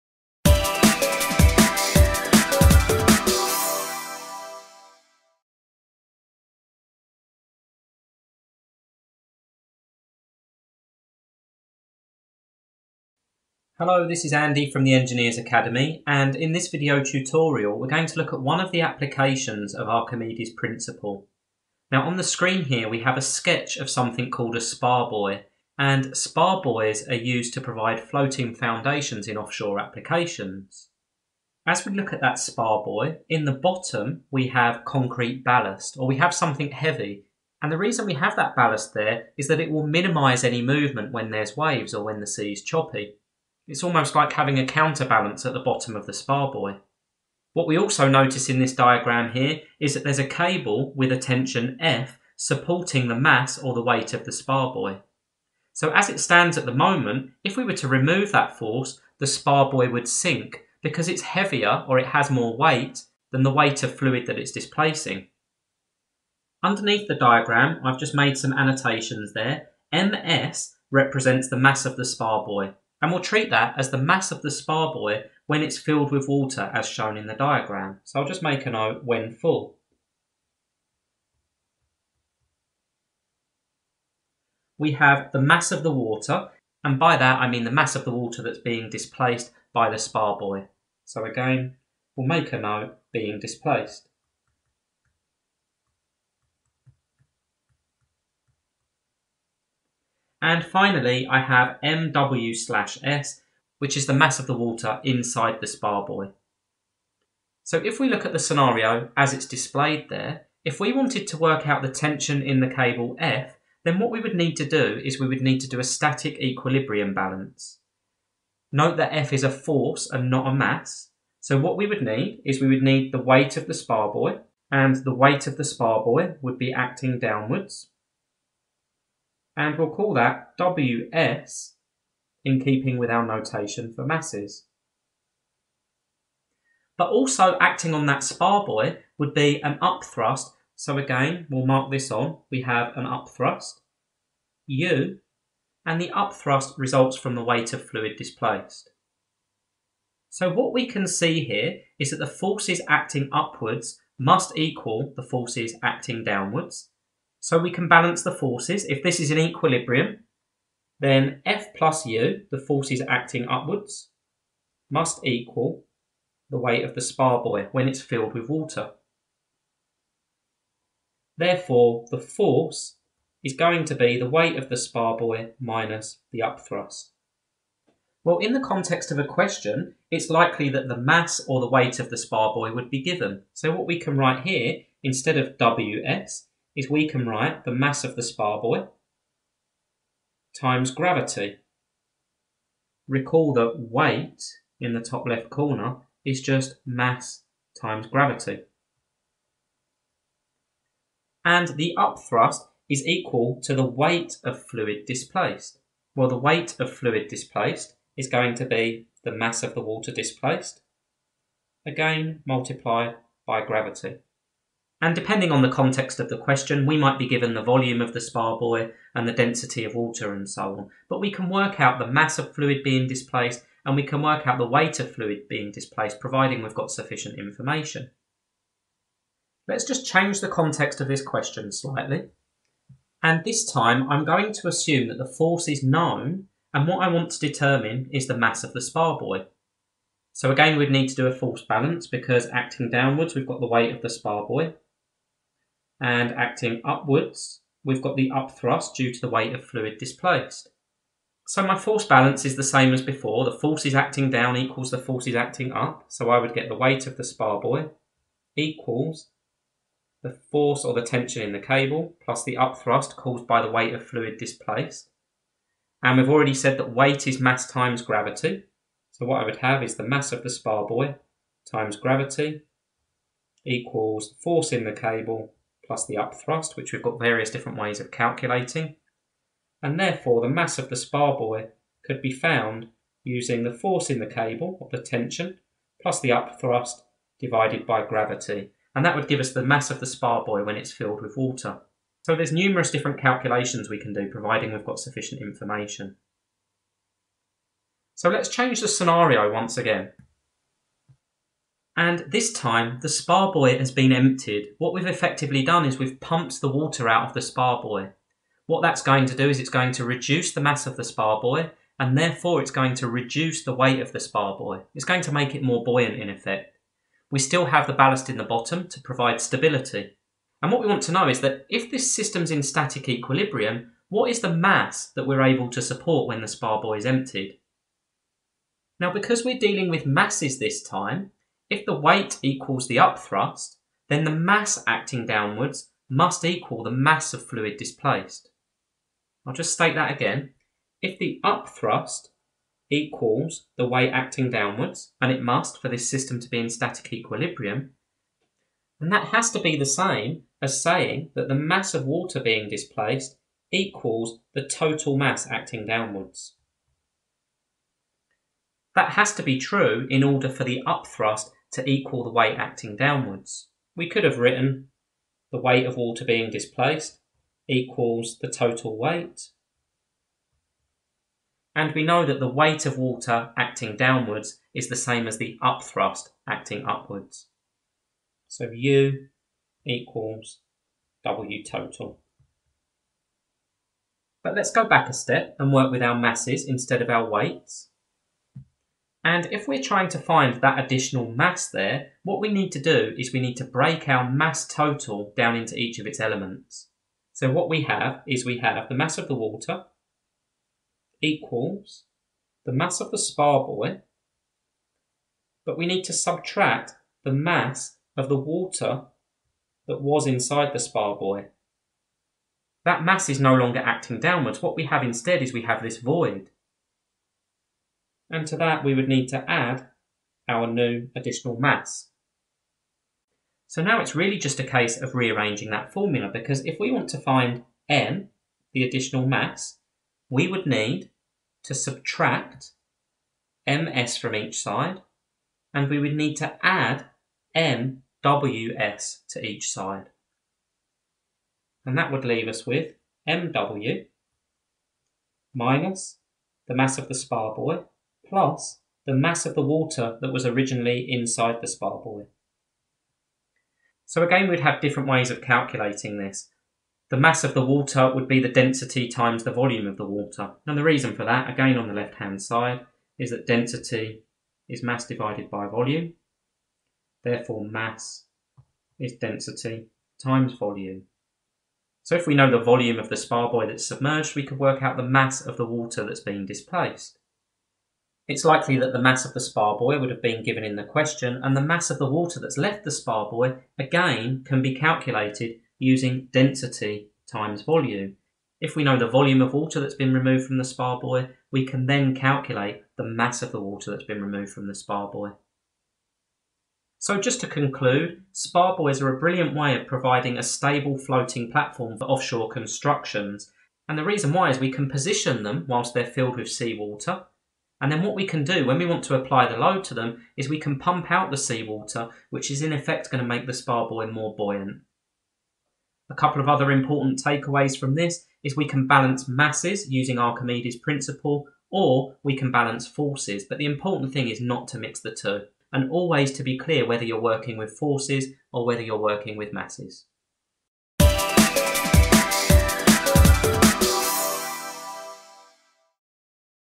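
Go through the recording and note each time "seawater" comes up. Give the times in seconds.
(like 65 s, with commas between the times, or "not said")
506 s, 511 s.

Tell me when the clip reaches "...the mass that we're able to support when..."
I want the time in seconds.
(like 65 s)
324 s.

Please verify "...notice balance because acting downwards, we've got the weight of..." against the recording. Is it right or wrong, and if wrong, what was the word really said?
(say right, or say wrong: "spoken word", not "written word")
wrong: "force", not "notice".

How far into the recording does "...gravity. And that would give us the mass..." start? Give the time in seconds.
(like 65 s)
288 s.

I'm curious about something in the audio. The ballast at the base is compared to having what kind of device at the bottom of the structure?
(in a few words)
a counterbalance.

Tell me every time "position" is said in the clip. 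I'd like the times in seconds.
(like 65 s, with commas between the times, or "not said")
504 s.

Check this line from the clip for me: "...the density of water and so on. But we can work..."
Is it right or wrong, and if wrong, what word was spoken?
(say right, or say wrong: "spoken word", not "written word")
right.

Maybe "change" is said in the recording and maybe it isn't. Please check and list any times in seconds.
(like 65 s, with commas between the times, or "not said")
230 s, 298 s.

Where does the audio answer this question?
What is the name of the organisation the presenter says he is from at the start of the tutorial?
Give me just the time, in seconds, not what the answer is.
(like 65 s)
14 s.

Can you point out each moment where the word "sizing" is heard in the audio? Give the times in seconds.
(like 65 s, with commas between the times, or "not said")
not said.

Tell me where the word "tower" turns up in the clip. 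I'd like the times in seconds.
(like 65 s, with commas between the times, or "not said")
not said.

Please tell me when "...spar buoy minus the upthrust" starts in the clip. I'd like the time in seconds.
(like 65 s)
174 s.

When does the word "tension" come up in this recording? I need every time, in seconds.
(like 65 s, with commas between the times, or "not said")
51 s, 111 s, 261 s, 285 s.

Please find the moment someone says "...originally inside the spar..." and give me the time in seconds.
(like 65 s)
450 s.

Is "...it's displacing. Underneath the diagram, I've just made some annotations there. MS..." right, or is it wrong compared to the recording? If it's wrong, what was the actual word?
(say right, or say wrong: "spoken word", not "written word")
right.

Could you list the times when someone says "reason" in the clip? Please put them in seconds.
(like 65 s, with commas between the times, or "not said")
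37 s, 460 s, 504 s.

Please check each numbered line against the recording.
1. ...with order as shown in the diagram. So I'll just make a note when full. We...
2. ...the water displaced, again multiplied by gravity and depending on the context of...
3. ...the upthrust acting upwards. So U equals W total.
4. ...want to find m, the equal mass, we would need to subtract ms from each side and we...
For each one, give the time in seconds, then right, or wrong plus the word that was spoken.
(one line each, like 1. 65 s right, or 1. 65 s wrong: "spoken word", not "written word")
1. 76 s wrong: "water", not "order"
2. 209 s right
3. 375 s right
4. 426 s wrong: "additional", not "equal".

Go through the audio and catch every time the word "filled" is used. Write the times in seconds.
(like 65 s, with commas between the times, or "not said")
75 s, 168 s, 290 s, 506 s.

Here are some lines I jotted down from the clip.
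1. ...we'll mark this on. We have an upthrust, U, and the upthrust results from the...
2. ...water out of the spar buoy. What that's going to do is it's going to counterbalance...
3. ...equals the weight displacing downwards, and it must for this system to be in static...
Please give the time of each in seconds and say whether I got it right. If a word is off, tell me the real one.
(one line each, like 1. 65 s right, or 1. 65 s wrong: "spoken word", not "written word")
1. 141 s right
2. 306 s wrong: "reduce", not "counterbalance"
3. 342 s wrong: "acting", not "displacing".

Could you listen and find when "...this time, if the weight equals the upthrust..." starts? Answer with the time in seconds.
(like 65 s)
330 s.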